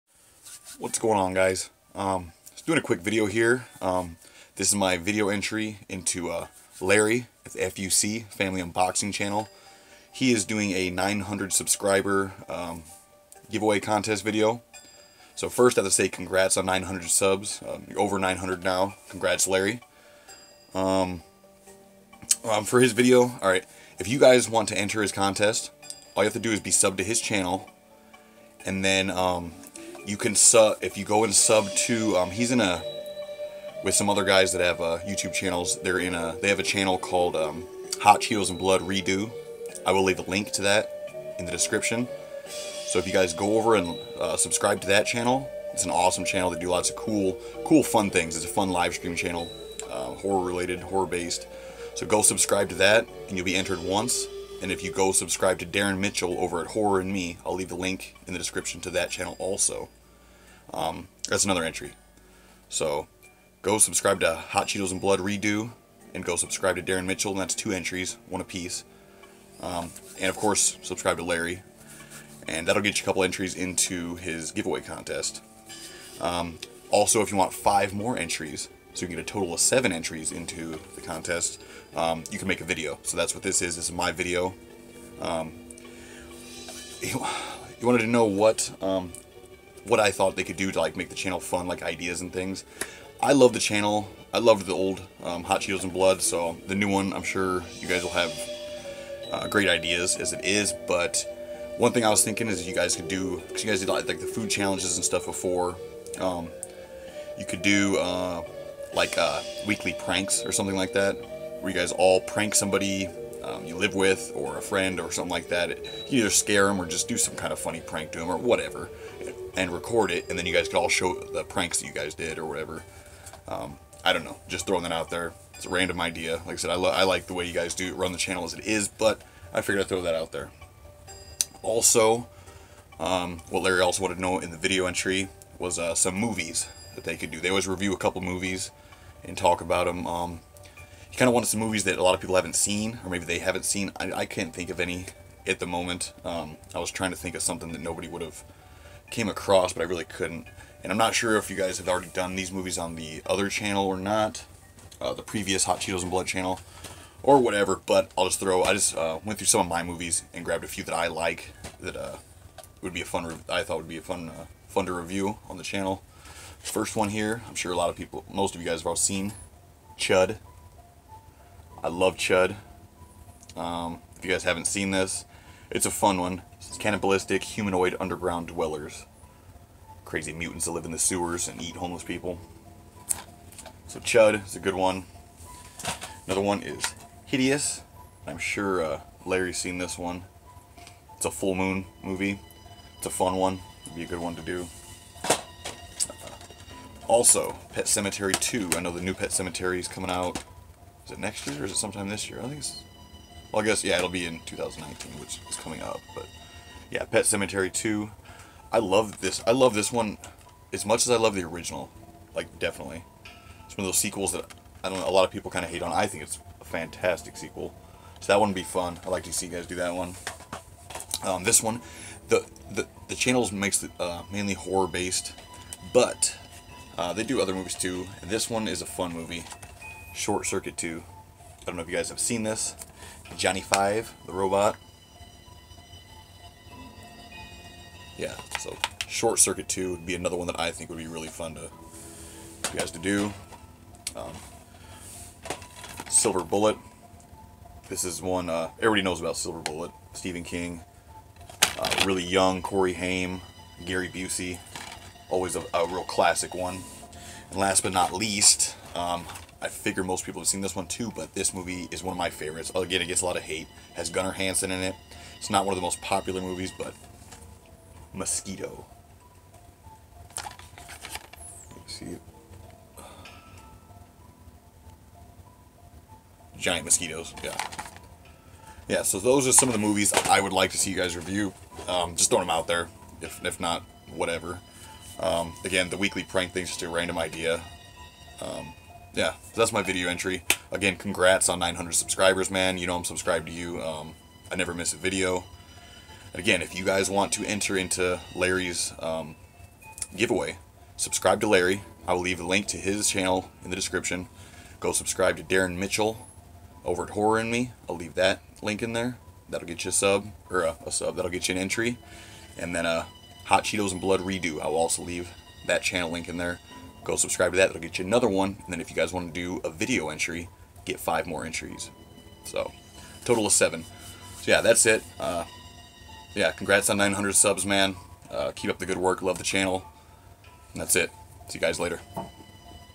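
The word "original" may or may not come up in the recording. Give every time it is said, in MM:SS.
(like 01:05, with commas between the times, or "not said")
03:31.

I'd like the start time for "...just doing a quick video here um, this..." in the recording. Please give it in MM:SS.
00:02.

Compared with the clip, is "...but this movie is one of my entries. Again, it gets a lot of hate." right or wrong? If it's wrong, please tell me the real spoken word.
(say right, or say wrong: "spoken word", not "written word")
wrong: "favorites", not "entries".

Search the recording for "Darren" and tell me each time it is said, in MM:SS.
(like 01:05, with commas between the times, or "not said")
00:55, 01:06, 05:05.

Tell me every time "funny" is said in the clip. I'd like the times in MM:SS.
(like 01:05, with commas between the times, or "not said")
01:57.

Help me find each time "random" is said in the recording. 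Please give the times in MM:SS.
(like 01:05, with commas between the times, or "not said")
02:05, 04:46.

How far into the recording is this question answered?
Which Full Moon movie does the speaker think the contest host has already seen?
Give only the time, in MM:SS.
03:07.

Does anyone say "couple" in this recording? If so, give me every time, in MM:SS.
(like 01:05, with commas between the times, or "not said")
01:13, 02:17.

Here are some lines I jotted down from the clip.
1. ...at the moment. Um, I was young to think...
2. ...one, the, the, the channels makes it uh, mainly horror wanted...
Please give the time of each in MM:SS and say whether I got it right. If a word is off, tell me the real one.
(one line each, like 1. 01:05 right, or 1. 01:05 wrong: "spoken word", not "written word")
1. 02:25 wrong: "trying", not "young"
2. 03:41 wrong: "based", not "wanted".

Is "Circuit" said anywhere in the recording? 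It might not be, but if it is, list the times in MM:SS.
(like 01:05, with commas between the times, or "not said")
03:50, 03:59.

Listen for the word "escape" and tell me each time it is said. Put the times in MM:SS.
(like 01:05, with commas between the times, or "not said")
not said.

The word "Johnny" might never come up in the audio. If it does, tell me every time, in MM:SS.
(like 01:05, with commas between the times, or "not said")
03:53.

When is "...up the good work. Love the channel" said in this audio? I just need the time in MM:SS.
05:28.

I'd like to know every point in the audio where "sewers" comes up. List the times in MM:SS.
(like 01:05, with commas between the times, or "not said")
03:00.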